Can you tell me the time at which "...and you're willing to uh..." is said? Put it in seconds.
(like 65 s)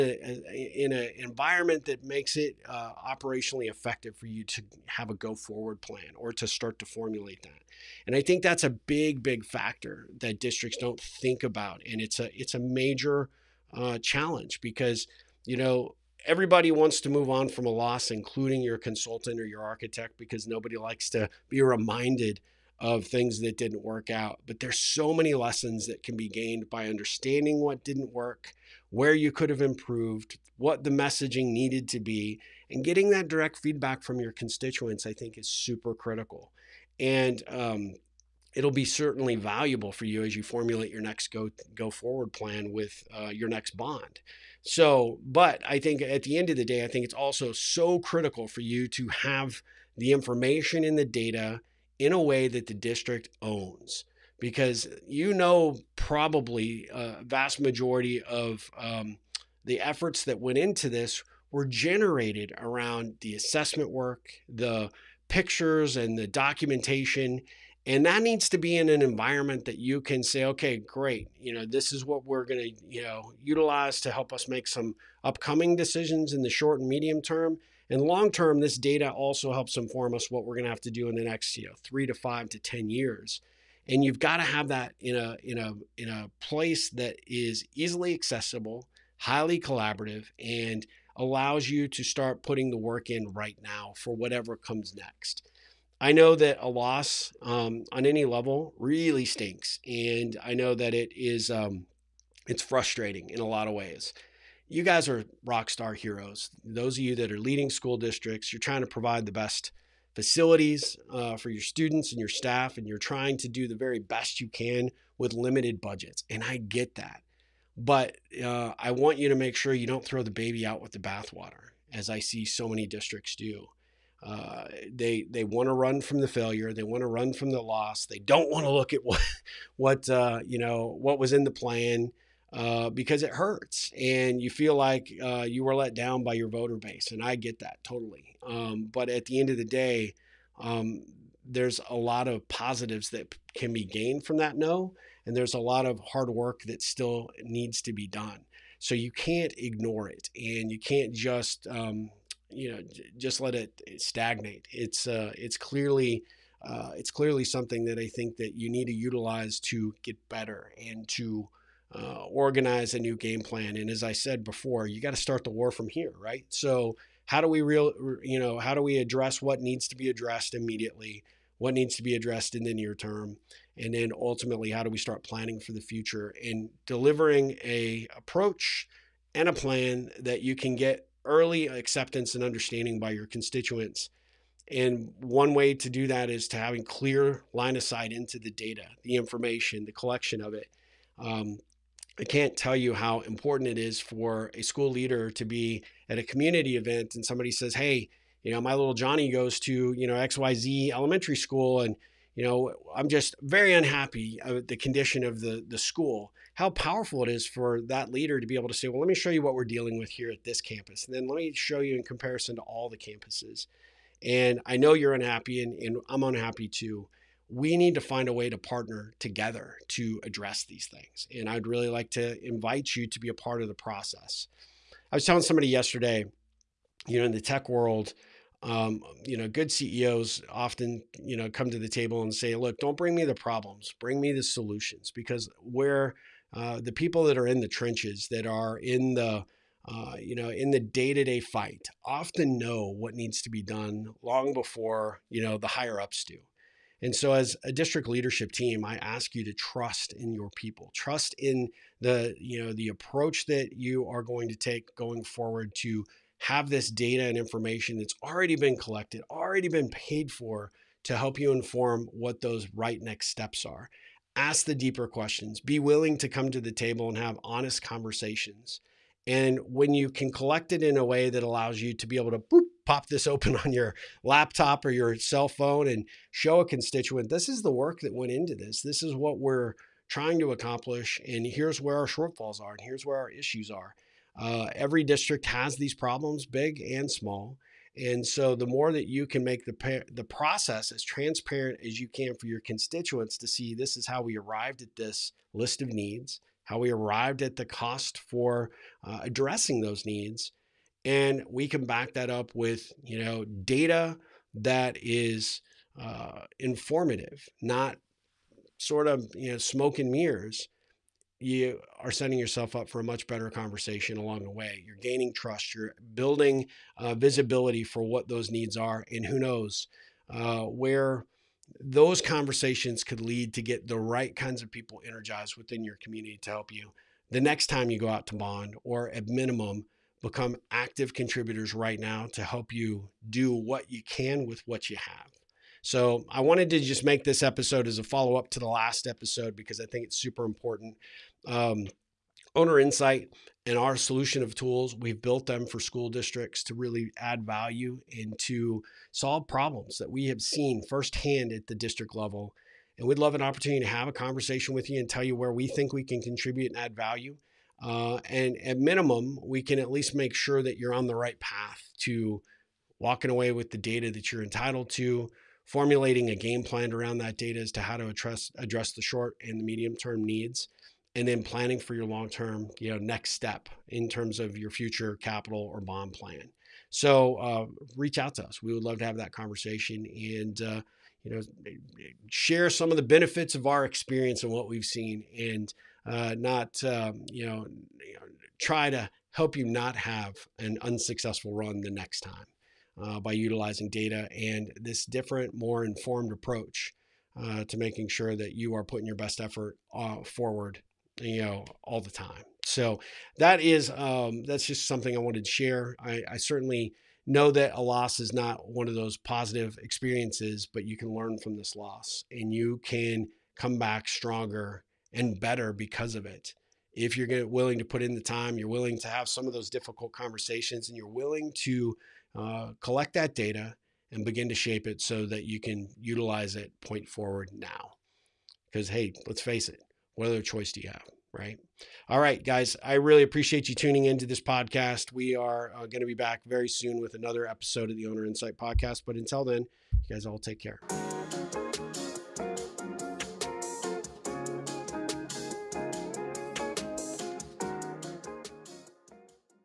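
420 s.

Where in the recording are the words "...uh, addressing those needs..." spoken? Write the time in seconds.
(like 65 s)
299 s.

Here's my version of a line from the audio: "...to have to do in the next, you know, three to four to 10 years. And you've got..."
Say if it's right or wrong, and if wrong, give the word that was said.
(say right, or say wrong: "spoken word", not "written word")
wrong: "five", not "four".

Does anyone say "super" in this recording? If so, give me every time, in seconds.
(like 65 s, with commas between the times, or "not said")
35 s, 340 s.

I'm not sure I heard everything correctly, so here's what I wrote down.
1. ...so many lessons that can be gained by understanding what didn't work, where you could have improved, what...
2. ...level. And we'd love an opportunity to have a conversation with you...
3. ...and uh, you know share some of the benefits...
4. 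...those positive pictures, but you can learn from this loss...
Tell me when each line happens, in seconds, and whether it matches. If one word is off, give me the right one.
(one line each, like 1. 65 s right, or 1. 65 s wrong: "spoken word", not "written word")
1. 24 s right
2. 352 s right
3. 380 s right
4. 408 s wrong: "experiences", not "pictures".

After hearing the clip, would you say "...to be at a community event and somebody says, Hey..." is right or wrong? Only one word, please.
right.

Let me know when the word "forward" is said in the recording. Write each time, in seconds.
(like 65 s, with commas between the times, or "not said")
5 s, 41 s, 255 s, 400 s, 427 s.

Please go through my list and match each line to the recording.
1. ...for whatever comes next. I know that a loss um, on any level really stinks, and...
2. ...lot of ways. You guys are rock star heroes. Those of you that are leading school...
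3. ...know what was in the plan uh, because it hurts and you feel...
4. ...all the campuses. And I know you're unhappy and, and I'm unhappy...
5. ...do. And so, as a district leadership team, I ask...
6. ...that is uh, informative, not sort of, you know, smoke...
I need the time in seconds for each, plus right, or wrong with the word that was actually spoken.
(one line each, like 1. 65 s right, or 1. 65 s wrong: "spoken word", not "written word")
1. 93 s right
2. 103 s right
3. 130 s right
4. 212 s right
5. 246 s right
6. 304 s right.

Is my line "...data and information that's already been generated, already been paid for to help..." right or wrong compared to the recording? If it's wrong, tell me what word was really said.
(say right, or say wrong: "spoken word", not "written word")
wrong: "collected", not "generated".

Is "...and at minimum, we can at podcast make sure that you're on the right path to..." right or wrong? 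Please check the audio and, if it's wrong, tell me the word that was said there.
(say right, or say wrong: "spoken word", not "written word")
wrong: "least", not "podcast".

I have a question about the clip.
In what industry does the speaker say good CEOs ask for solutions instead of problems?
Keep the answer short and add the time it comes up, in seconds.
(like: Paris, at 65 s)
Tech, at 227 s.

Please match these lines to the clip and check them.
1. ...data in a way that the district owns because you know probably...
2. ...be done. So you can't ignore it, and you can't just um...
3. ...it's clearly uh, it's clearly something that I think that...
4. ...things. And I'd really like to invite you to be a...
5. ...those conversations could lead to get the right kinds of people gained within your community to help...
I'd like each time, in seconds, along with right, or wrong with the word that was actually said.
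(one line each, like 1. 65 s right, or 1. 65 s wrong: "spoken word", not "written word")
1. 51 s right
2. 147 s right
3. 155 s right
4. 220 s right
5. 321 s wrong: "energized", not "gained".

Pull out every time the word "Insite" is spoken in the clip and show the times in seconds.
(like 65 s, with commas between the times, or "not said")
342 s, 438 s.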